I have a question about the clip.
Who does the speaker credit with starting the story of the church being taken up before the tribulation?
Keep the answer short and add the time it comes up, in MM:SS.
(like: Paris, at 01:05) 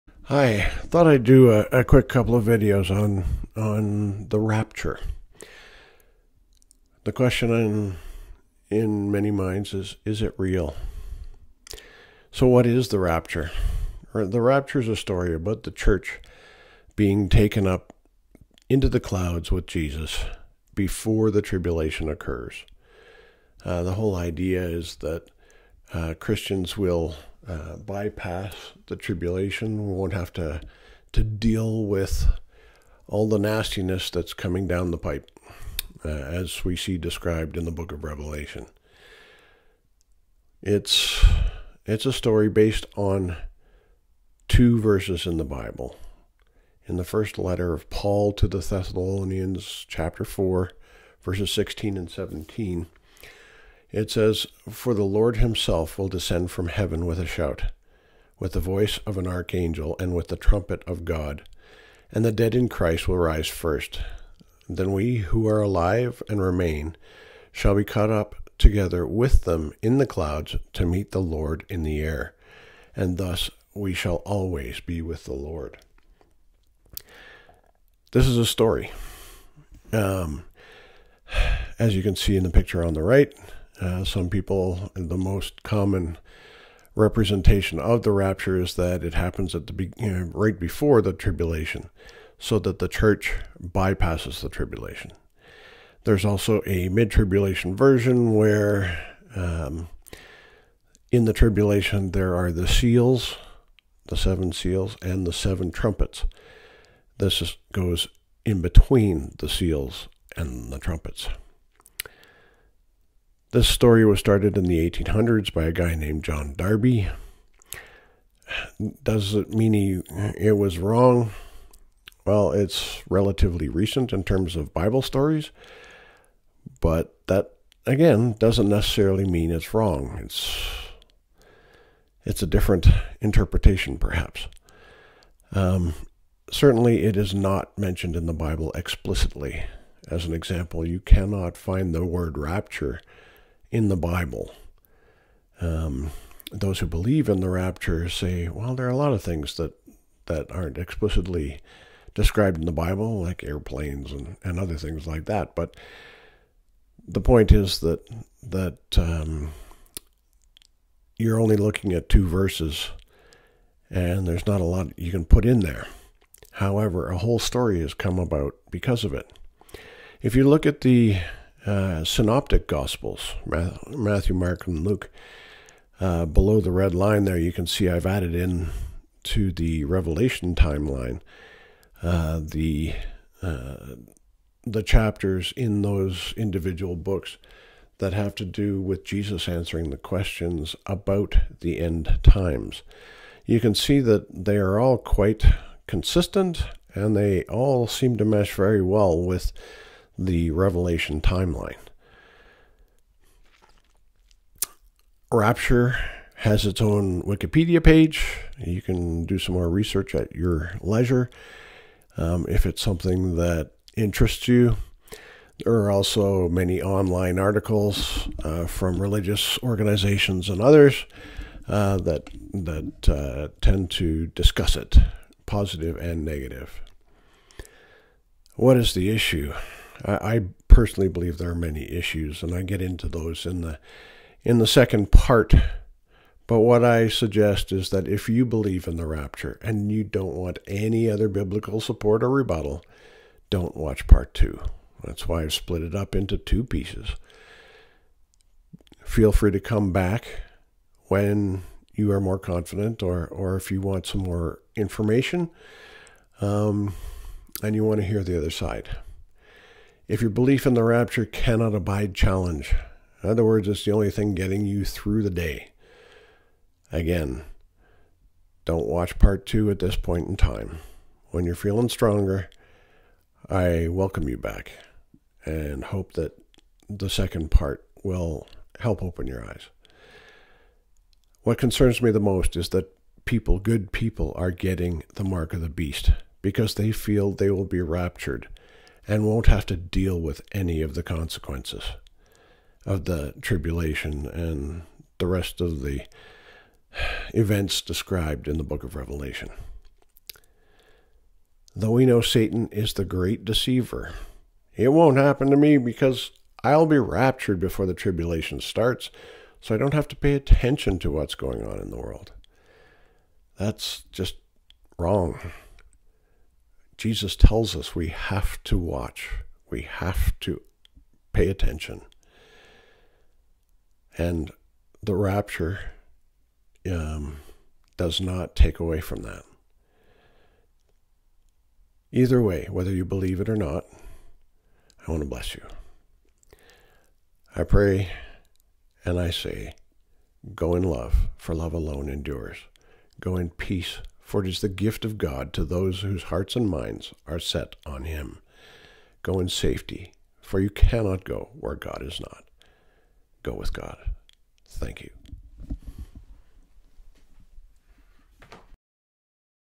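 John Darby, at 01:56.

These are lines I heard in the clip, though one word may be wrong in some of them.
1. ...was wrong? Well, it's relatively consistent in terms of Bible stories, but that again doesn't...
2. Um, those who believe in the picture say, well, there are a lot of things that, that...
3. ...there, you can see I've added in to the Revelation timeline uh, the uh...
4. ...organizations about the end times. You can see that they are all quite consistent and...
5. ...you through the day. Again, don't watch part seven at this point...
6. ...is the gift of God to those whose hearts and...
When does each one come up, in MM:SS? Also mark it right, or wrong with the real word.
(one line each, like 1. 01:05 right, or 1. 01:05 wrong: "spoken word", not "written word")
1. 02:00 wrong: "recent", not "consistent"
2. 02:25 wrong: "rapture", not "picture"
3. 02:57 right
4. 03:09 wrong: "questions", not "organizations"
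5. 04:24 wrong: "two", not "seven"
6. 05:44 right.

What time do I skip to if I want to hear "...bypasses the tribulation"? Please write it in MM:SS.
01:33.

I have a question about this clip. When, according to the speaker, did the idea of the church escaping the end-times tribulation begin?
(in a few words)
1800s.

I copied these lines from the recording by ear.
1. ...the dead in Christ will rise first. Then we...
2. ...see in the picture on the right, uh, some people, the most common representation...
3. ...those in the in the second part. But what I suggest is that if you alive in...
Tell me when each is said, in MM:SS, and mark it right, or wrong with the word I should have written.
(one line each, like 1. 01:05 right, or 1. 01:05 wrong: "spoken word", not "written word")
1. 01:02 right
2. 01:22 right
3. 03:53 wrong: "believe", not "alive".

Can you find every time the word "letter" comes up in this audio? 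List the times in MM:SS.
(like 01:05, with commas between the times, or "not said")
00:47.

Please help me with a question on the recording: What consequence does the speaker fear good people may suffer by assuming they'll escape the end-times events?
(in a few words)
the mark of the beast.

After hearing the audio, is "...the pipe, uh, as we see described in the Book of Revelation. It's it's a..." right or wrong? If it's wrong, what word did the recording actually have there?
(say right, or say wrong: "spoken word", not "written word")
right.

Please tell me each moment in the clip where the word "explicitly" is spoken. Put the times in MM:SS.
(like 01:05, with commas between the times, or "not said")
02:18, 02:30.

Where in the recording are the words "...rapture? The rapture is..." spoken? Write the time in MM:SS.
00:12.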